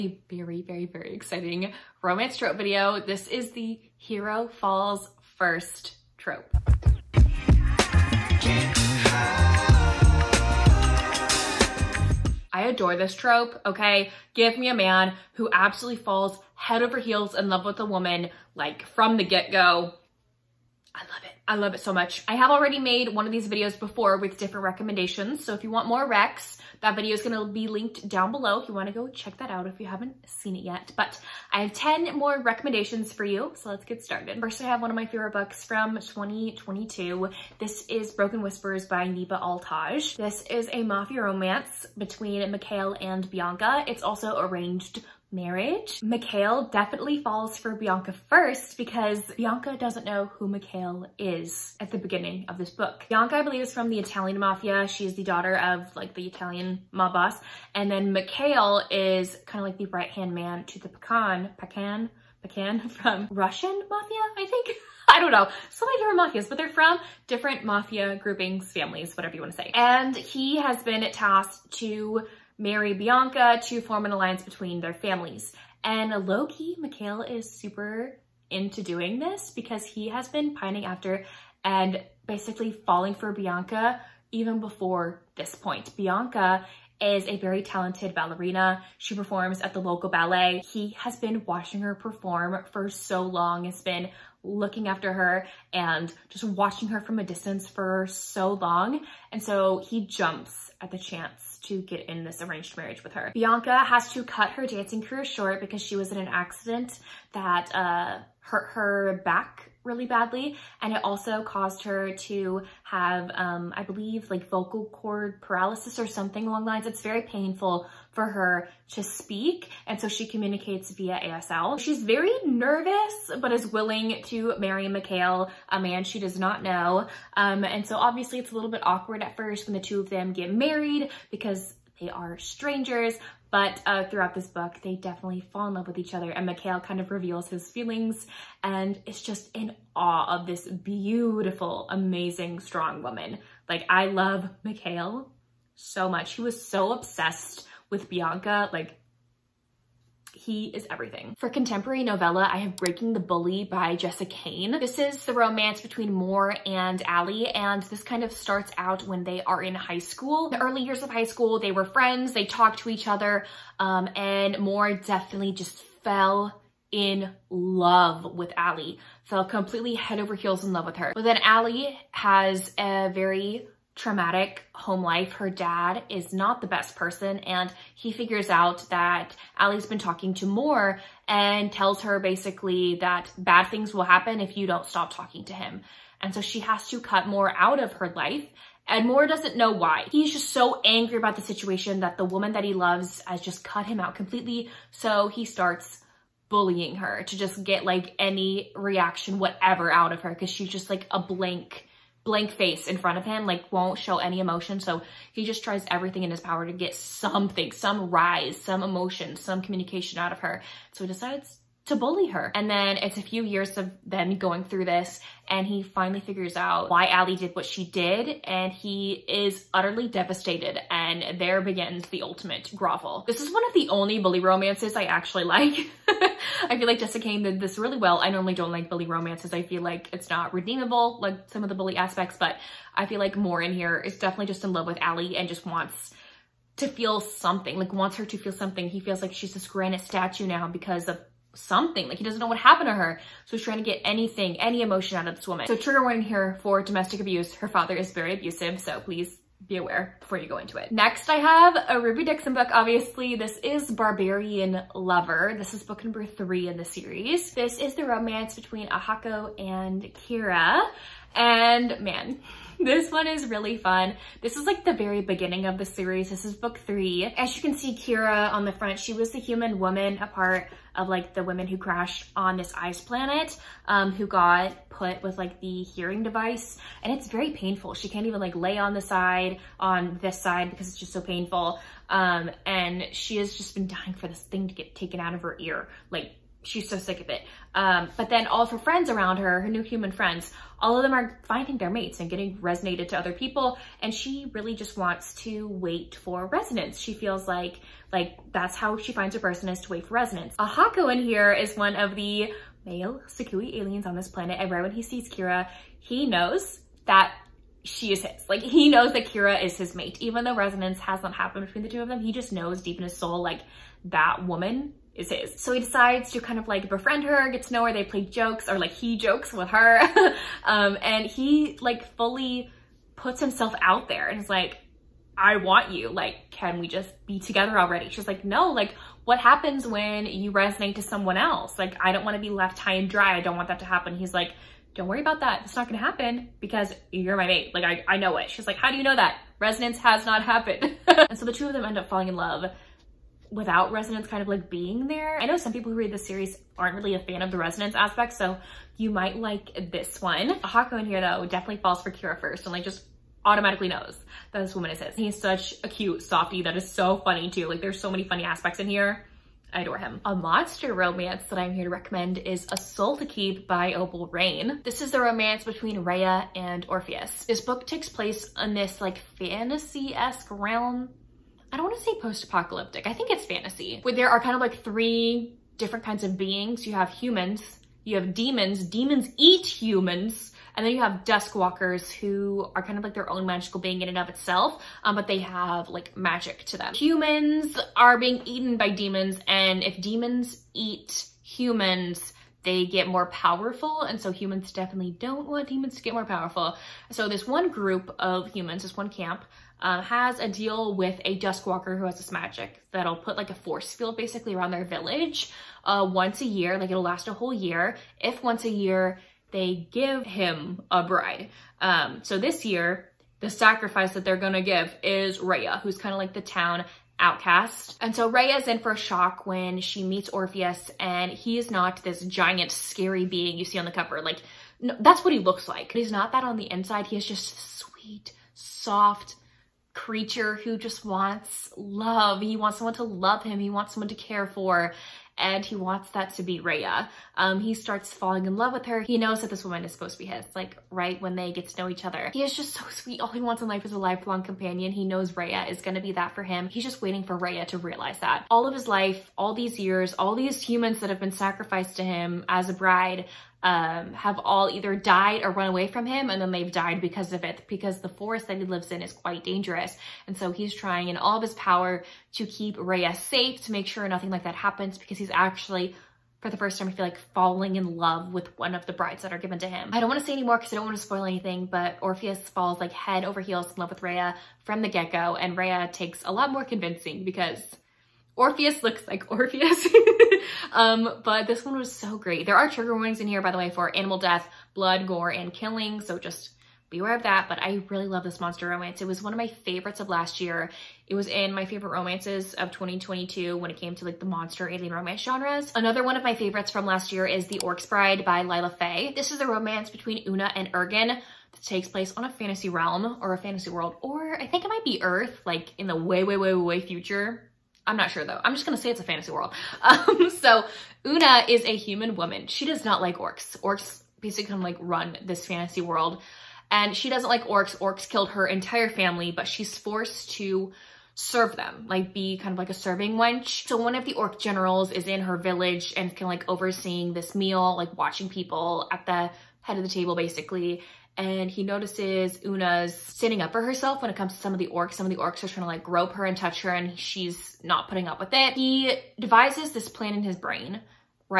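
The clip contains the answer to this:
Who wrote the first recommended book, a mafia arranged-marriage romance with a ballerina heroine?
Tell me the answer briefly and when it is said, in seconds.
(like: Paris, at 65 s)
Neva Altaj, at 39 s.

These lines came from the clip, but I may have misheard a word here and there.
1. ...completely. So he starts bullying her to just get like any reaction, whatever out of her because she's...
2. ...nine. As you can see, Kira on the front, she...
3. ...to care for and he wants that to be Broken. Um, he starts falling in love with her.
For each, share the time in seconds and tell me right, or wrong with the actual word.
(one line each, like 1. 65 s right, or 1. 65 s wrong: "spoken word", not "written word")
1. 194 s right
2. 266 s wrong: "three", not "nine"
3. 434 s wrong: "Rhea", not "Broken".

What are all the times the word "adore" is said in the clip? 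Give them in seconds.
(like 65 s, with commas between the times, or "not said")
12 s, 359 s.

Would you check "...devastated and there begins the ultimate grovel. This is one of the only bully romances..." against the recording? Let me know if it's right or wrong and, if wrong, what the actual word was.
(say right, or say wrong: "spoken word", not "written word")
right.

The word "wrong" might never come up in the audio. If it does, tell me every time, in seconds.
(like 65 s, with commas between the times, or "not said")
not said.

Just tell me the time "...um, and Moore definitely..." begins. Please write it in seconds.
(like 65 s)
163 s.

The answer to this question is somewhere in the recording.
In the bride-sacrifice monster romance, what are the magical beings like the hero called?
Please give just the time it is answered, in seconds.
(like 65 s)
381 s.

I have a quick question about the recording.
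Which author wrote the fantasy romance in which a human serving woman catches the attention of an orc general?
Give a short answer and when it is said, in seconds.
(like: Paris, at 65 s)
Lila Faye, at 498 s.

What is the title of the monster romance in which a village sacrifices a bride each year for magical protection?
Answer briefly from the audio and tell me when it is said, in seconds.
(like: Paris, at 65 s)
A Soul to Keep, at 362 s.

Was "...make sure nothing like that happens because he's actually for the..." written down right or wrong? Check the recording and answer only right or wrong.
right.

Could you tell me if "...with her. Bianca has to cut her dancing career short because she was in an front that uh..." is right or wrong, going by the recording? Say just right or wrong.
wrong.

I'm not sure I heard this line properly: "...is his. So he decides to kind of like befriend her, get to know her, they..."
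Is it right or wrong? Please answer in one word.
right.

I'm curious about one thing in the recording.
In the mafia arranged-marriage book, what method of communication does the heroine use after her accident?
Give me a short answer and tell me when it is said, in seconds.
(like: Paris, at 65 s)
ASL, at 121 s.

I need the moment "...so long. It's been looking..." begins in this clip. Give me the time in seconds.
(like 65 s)
92 s.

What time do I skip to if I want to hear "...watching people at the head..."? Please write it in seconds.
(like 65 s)
527 s.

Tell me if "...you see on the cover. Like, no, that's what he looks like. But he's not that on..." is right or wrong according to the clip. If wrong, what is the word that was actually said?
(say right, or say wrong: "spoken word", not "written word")
right.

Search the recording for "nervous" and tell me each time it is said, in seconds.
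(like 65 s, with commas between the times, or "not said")
122 s.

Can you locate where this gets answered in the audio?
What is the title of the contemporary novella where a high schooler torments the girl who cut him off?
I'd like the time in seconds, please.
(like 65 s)
152 s.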